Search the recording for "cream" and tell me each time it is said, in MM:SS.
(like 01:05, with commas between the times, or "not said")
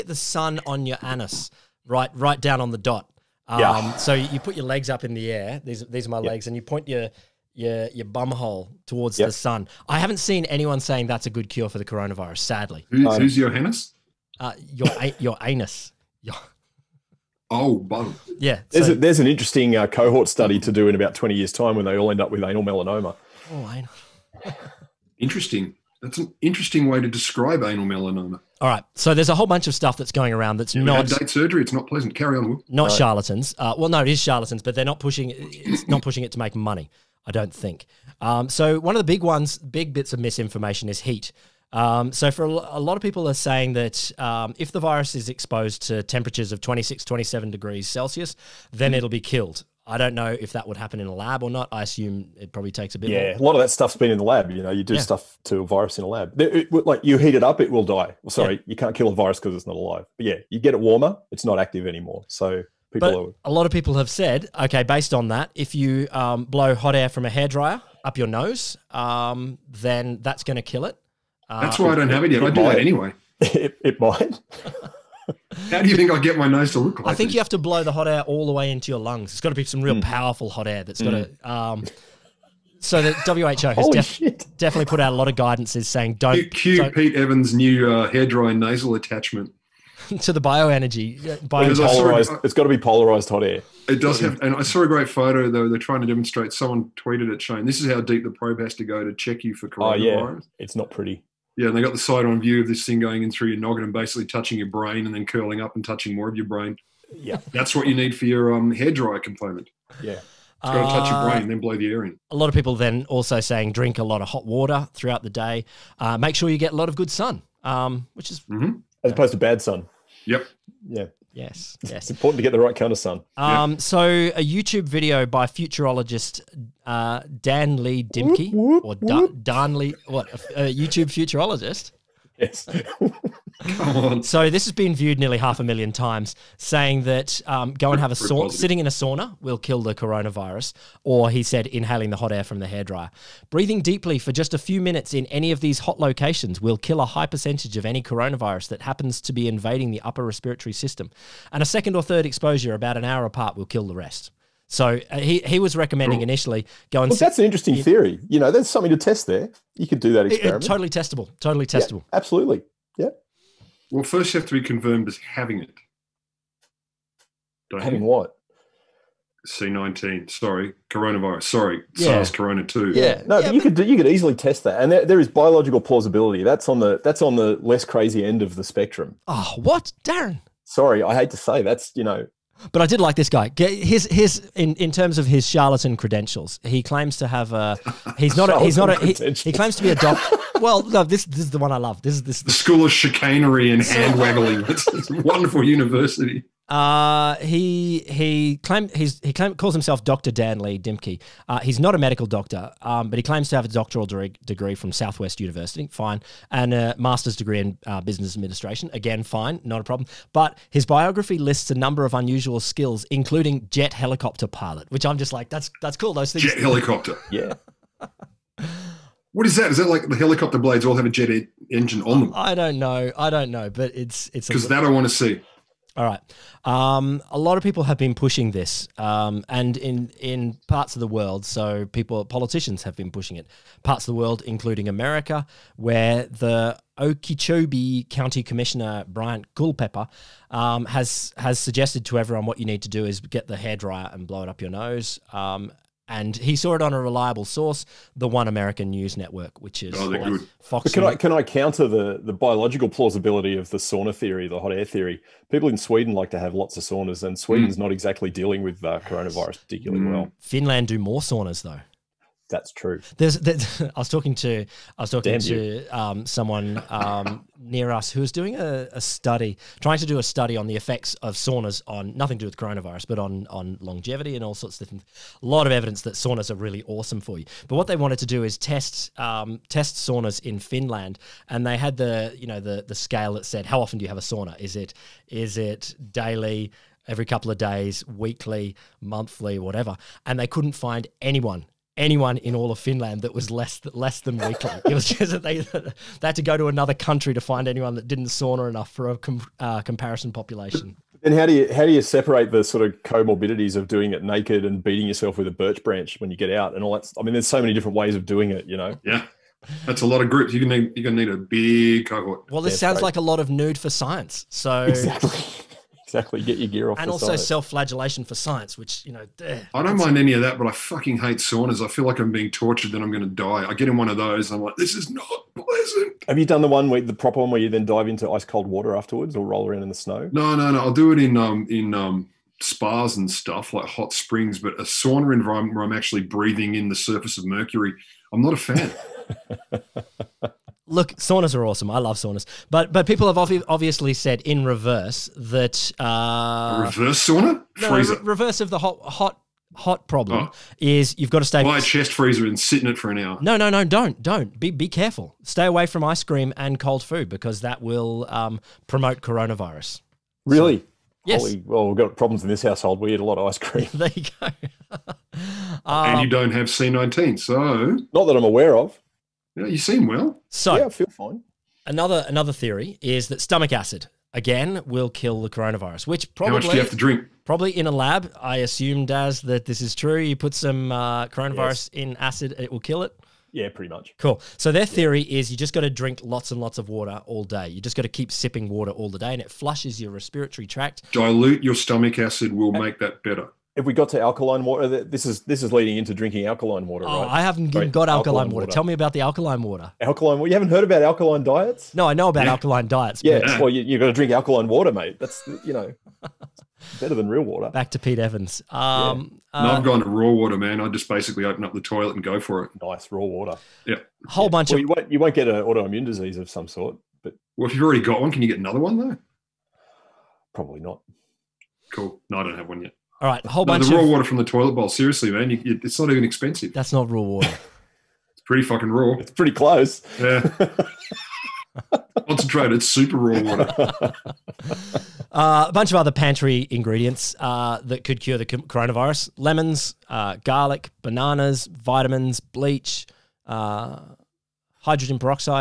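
05:56, 06:03.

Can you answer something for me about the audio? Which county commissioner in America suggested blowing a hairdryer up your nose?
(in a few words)
Bryant Culpepper.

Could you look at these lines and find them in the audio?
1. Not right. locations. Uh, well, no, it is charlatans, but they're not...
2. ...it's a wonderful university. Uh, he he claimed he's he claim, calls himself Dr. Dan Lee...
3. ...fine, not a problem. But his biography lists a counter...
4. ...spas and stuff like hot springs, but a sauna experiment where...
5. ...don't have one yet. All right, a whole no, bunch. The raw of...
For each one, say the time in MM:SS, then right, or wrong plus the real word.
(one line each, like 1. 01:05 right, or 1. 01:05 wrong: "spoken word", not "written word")
1. 00:32 wrong: "charlatans", not "locations"
2. 03:14 right
3. 03:29 wrong: "number", not "counter"
4. 05:32 wrong: "environment", not "experiment"
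5. 07:02 right.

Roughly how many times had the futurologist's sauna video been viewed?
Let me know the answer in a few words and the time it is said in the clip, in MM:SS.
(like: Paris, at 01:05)
half a million, at 02:15.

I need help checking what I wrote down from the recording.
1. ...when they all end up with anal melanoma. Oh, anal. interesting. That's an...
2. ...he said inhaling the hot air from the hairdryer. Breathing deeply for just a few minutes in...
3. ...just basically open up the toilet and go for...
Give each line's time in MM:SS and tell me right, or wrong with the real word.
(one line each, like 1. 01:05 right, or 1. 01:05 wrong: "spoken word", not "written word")
1. 00:21 right
2. 02:21 right
3. 06:50 right.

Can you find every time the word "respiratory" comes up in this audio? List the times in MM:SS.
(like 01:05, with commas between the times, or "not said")
02:30, 06:30.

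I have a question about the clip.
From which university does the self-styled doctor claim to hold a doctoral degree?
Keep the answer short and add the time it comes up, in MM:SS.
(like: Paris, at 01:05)
Southwest University, at 03:24.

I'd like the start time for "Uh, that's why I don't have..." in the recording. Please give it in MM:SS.
01:11.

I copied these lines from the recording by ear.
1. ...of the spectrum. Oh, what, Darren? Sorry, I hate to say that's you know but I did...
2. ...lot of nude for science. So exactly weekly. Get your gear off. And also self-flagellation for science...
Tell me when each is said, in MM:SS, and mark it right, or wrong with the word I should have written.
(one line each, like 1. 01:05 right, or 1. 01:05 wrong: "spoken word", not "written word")
1. 02:58 right
2. 05:13 wrong: "exactly", not "weekly".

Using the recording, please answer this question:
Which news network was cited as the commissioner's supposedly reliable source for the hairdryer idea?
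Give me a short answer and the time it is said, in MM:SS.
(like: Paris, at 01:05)
One American News Network, at 04:08.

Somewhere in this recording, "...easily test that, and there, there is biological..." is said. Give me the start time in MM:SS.
02:54.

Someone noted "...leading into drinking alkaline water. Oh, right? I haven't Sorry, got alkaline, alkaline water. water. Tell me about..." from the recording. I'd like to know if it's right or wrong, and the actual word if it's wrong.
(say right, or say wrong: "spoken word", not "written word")
right.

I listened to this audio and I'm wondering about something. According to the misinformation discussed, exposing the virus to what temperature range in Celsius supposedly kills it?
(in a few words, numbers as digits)
26, 27 degrees.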